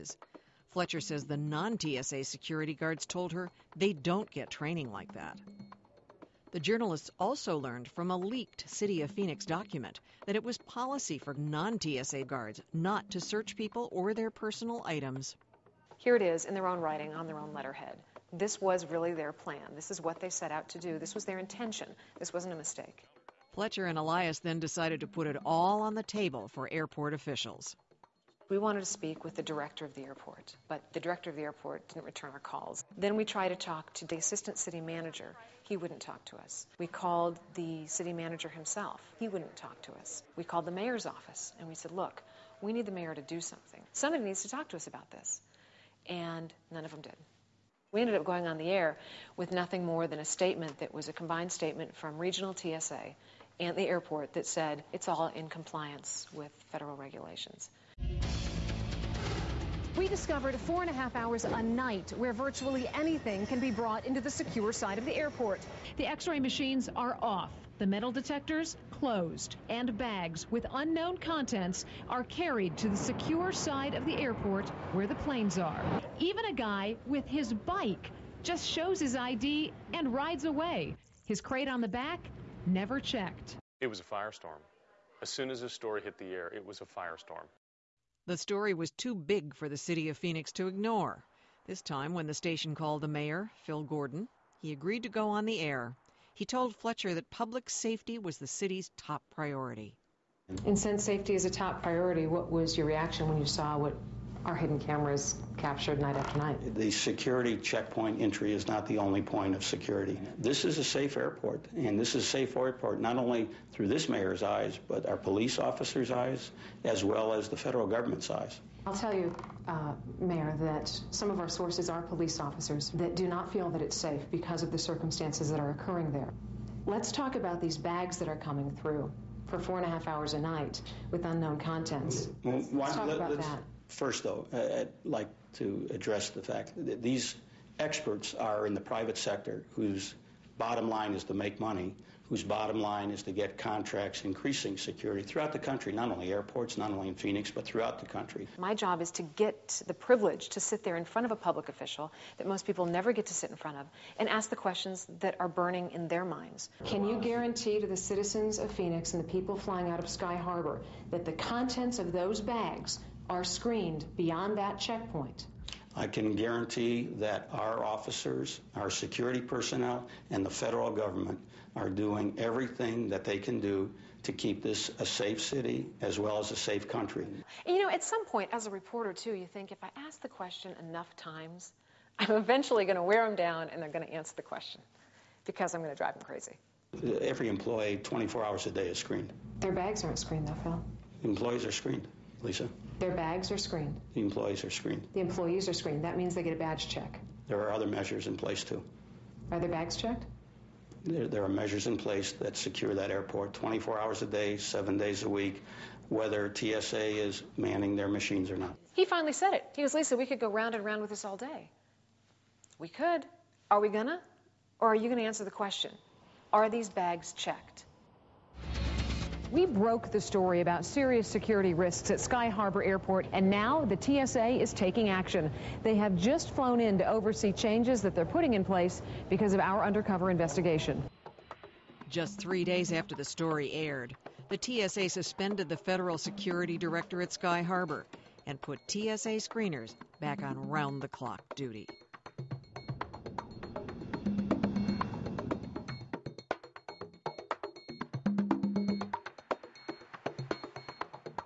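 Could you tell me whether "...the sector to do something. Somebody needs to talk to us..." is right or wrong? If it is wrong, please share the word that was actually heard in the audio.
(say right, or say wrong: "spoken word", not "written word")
wrong: "mayor", not "sector".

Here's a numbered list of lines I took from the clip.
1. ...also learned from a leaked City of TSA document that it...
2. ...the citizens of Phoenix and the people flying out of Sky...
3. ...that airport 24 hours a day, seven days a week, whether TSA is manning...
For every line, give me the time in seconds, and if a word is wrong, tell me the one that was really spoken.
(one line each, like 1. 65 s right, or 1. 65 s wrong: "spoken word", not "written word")
1. 7 s wrong: "Phoenix", not "TSA"
2. 157 s right
3. 202 s right.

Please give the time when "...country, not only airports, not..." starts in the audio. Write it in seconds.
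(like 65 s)
145 s.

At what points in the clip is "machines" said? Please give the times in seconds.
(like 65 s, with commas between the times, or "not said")
66 s, 208 s.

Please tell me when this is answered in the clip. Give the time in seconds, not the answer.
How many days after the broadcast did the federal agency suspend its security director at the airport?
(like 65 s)
232 s.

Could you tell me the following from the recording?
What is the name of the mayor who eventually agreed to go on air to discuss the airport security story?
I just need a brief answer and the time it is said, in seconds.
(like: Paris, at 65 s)
Phil Gordon, at 93 s.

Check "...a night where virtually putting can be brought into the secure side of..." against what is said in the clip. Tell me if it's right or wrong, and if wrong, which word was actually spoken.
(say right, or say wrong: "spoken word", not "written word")
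wrong: "anything", not "putting".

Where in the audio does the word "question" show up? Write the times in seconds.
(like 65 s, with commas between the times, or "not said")
154 s, 180 s, 184 s, 215 s.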